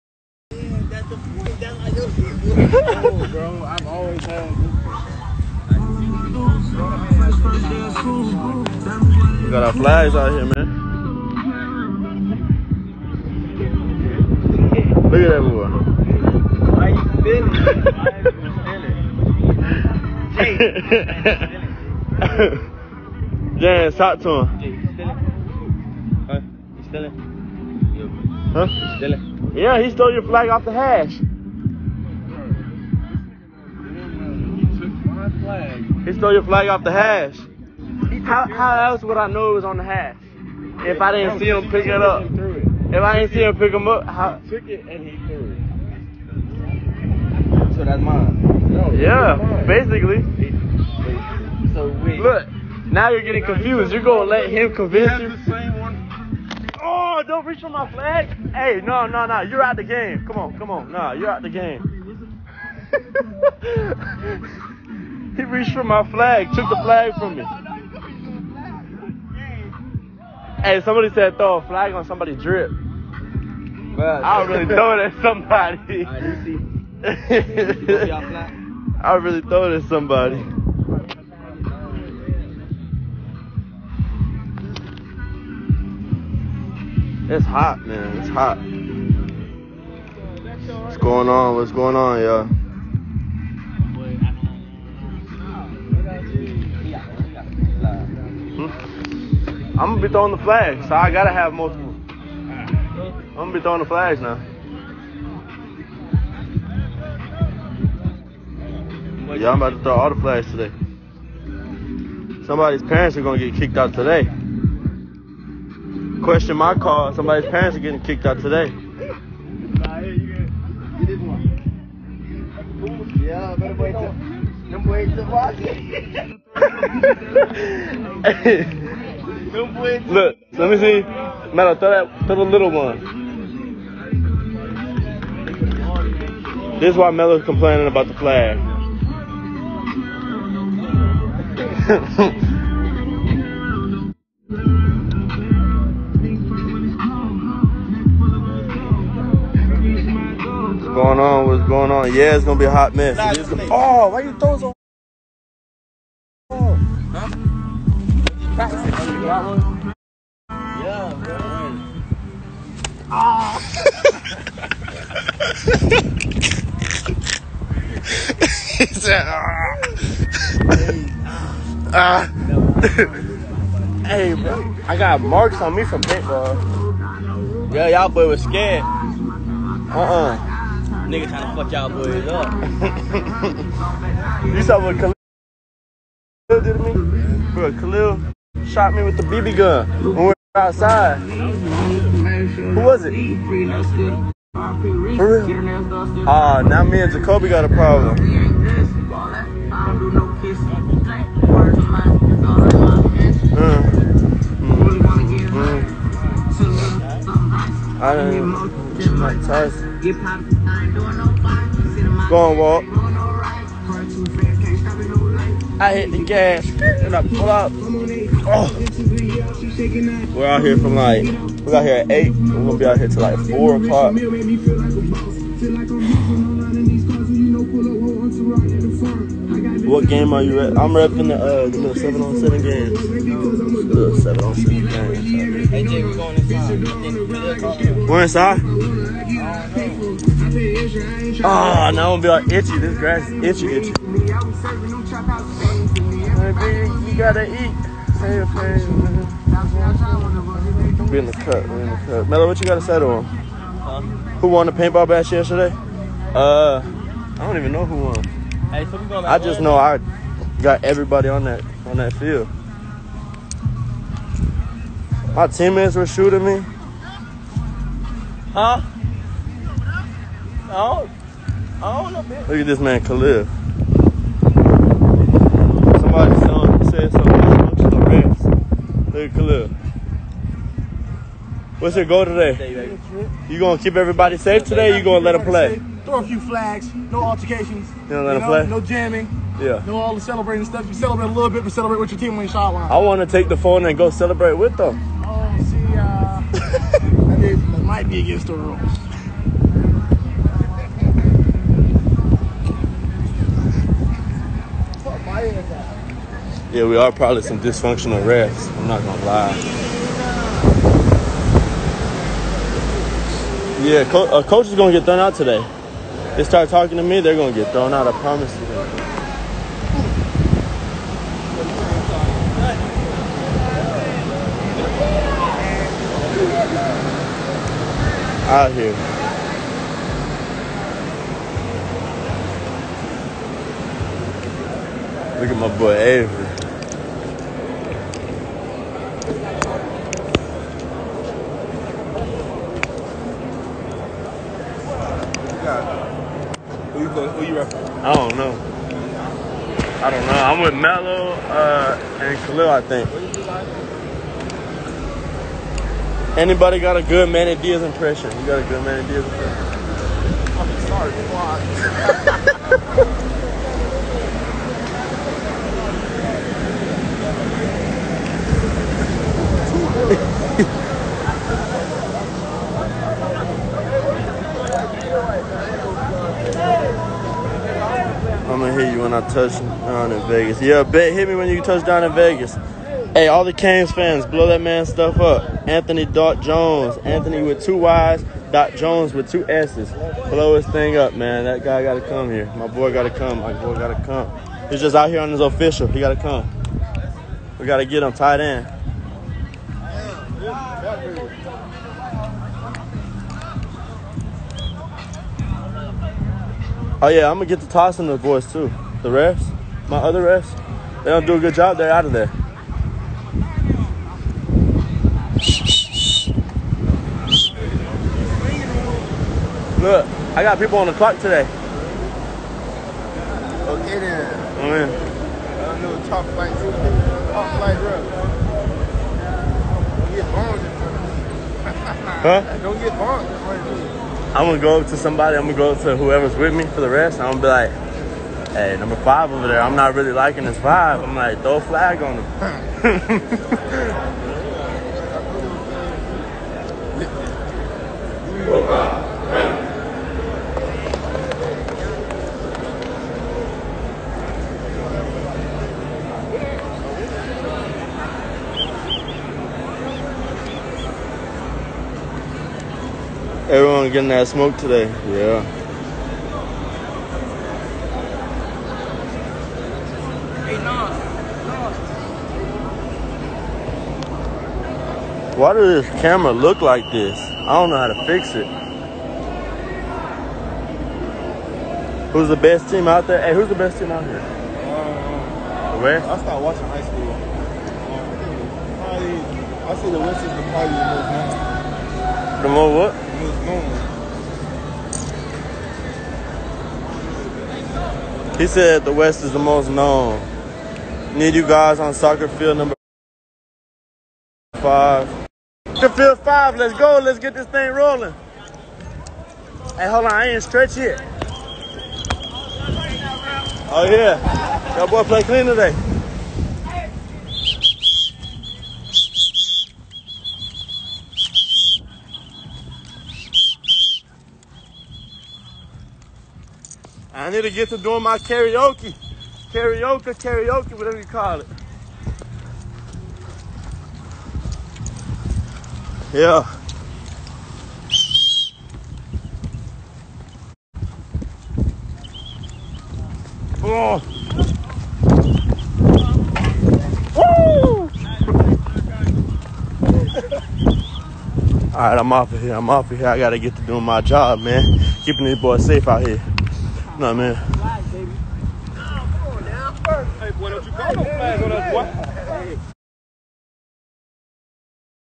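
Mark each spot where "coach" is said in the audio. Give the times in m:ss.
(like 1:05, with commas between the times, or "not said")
5:14.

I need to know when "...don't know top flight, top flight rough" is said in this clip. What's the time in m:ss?
7:05.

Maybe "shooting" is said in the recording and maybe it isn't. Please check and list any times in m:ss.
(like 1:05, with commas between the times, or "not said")
4:26.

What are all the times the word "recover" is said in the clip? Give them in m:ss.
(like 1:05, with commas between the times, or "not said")
not said.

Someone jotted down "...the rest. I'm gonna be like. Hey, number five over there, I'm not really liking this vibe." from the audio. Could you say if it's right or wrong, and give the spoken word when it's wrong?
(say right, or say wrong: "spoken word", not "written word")
right.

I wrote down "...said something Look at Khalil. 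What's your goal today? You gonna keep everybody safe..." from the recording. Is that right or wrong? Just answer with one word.
right.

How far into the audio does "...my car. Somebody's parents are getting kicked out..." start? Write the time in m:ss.
1:56.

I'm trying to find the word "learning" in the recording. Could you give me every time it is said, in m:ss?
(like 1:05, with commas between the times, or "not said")
not said.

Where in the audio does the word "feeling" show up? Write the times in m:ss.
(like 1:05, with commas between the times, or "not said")
0:20.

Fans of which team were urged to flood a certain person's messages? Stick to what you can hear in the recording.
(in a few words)
Canes.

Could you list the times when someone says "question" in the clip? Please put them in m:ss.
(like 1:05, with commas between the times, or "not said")
1:56.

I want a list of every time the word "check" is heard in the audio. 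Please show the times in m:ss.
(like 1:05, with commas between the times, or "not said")
not said.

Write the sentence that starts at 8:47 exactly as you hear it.
I need to get to doing my karaoke.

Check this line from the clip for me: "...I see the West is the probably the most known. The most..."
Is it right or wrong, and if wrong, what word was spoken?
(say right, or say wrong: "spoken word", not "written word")
right.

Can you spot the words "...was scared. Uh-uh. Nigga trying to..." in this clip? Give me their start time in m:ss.
2:58.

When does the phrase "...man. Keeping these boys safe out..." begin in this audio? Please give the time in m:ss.
9:14.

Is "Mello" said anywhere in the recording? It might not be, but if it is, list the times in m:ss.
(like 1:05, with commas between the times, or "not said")
4:12, 5:50.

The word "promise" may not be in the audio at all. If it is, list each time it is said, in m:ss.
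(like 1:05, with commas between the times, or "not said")
5:18.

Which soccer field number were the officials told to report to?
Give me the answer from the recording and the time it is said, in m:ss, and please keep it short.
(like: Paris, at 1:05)
5, at 8:21.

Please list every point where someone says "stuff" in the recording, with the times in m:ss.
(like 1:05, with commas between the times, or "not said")
4:50, 6:24.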